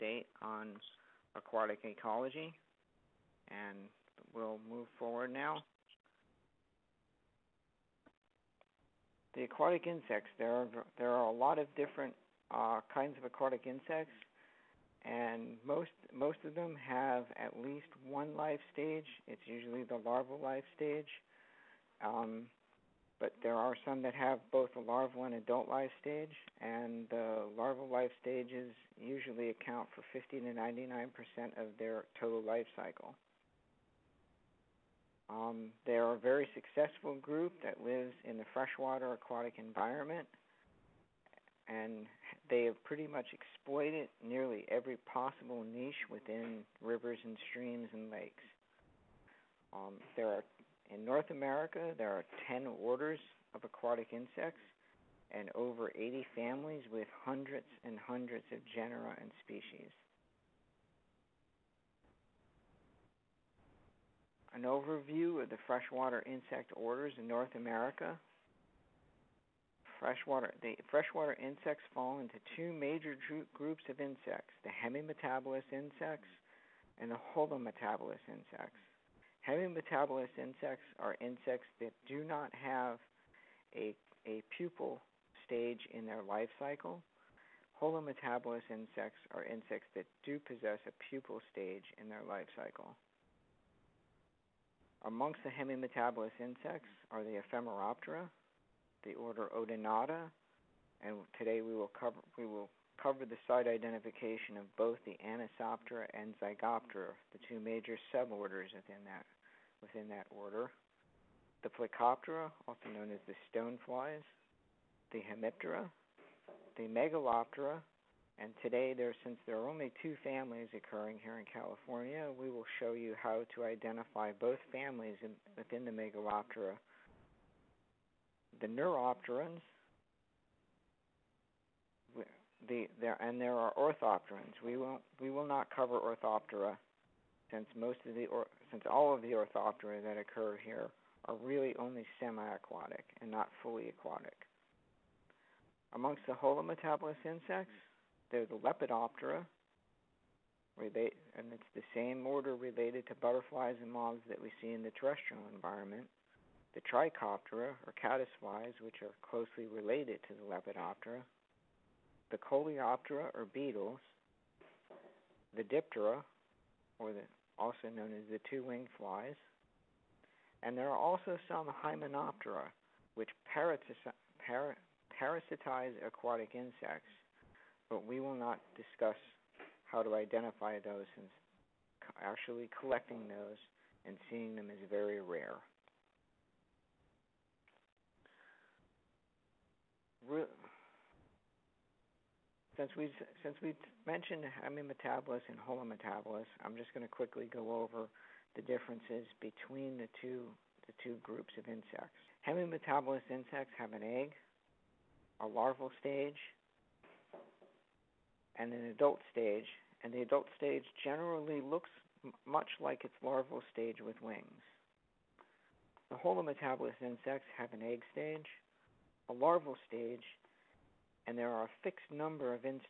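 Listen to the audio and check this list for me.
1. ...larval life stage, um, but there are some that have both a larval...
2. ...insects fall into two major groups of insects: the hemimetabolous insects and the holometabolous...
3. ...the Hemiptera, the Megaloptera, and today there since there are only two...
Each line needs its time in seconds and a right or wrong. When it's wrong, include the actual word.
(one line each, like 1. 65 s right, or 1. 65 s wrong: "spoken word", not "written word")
1. 20 s right
2. 71 s right
3. 115 s right.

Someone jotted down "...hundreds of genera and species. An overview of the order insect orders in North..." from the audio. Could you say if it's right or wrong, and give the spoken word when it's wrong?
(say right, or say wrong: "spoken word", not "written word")
wrong: "freshwater", not "order".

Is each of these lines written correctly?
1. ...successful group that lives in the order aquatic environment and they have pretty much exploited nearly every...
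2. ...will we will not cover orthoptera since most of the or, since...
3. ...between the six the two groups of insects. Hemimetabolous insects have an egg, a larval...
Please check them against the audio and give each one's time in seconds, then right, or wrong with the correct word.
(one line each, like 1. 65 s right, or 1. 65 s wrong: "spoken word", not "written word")
1. 36 s wrong: "freshwater", not "order"
2. 134 s right
3. 199 s wrong: "two", not "six".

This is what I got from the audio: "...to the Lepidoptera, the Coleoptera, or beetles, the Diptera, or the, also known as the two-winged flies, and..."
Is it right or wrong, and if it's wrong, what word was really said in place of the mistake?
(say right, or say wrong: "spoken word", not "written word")
right.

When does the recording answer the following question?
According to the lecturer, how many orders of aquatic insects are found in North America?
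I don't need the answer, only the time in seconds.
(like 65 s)
52 s.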